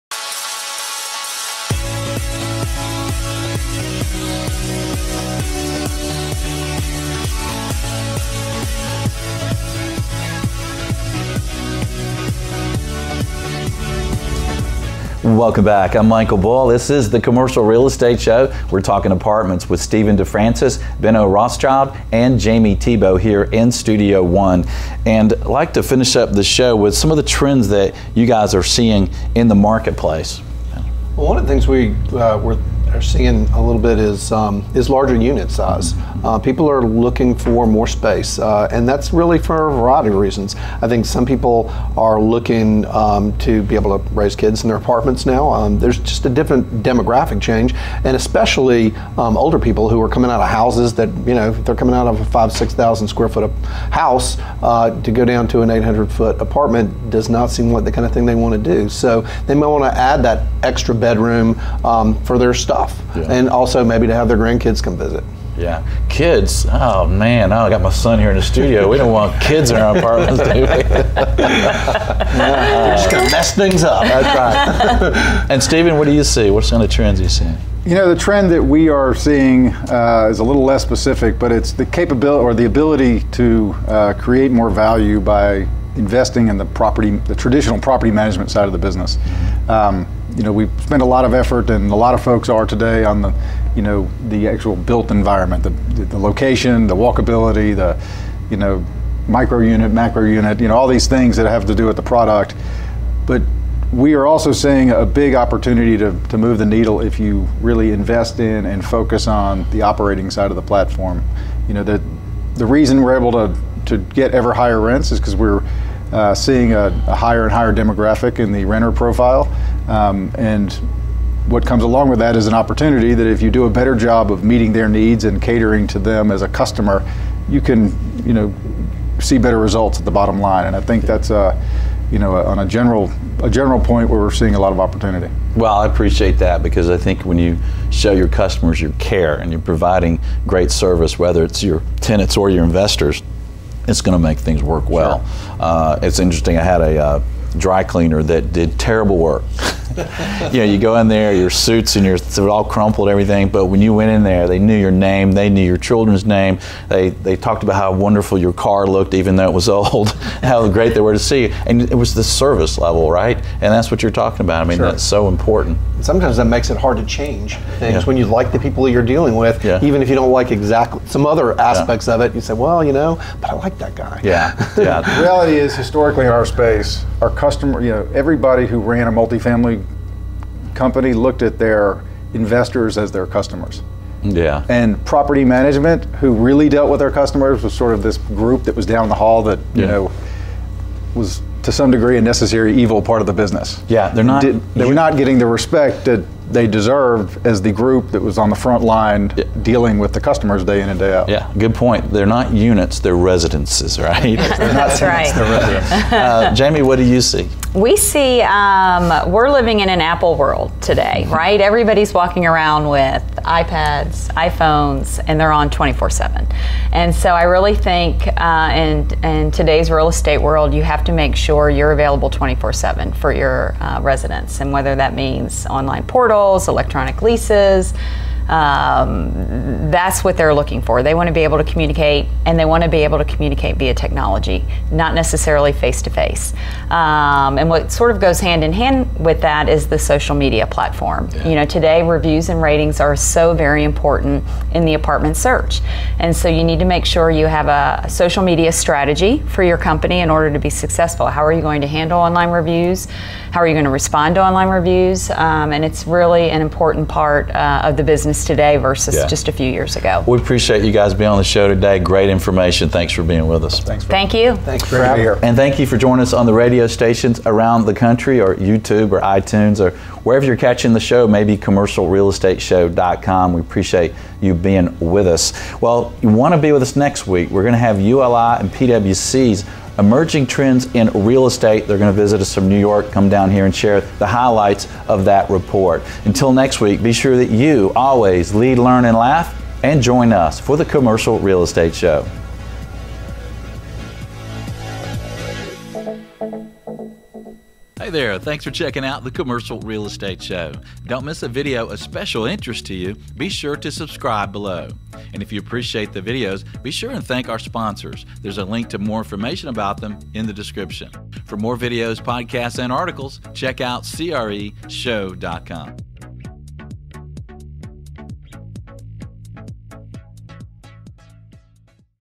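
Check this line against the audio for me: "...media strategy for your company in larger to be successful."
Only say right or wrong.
wrong.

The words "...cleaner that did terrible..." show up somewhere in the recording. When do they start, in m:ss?
2:27.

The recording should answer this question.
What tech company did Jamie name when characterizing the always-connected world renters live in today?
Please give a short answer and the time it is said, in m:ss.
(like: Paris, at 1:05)
Apple, at 3:30.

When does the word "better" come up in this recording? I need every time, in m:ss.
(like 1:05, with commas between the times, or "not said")
2:03, 2:09.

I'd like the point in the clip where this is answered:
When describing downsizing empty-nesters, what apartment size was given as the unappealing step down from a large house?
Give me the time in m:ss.
0:55.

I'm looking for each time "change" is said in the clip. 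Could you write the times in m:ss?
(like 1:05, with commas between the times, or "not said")
0:47, 2:47.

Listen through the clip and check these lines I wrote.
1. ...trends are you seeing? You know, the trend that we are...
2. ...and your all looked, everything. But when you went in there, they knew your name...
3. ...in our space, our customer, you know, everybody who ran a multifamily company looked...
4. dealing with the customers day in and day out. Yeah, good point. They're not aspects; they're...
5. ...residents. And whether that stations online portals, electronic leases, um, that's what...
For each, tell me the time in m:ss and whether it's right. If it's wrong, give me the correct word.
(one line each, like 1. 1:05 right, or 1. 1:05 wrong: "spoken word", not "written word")
1. 1:16 right
2. 2:31 wrong: "crumpled", not "looked"
3. 2:56 right
4. 3:19 wrong: "units", not "aspects"
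5. 3:44 wrong: "means", not "stations".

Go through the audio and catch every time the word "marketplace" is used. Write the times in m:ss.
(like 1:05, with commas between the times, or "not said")
0:29.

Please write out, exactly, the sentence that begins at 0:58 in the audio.
So they might want to add that extra bedroom um, for their stuff stuff, yeah.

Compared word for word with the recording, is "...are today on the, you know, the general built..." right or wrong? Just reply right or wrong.
wrong.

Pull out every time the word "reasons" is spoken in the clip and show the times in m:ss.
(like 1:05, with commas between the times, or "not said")
0:40, 1:52.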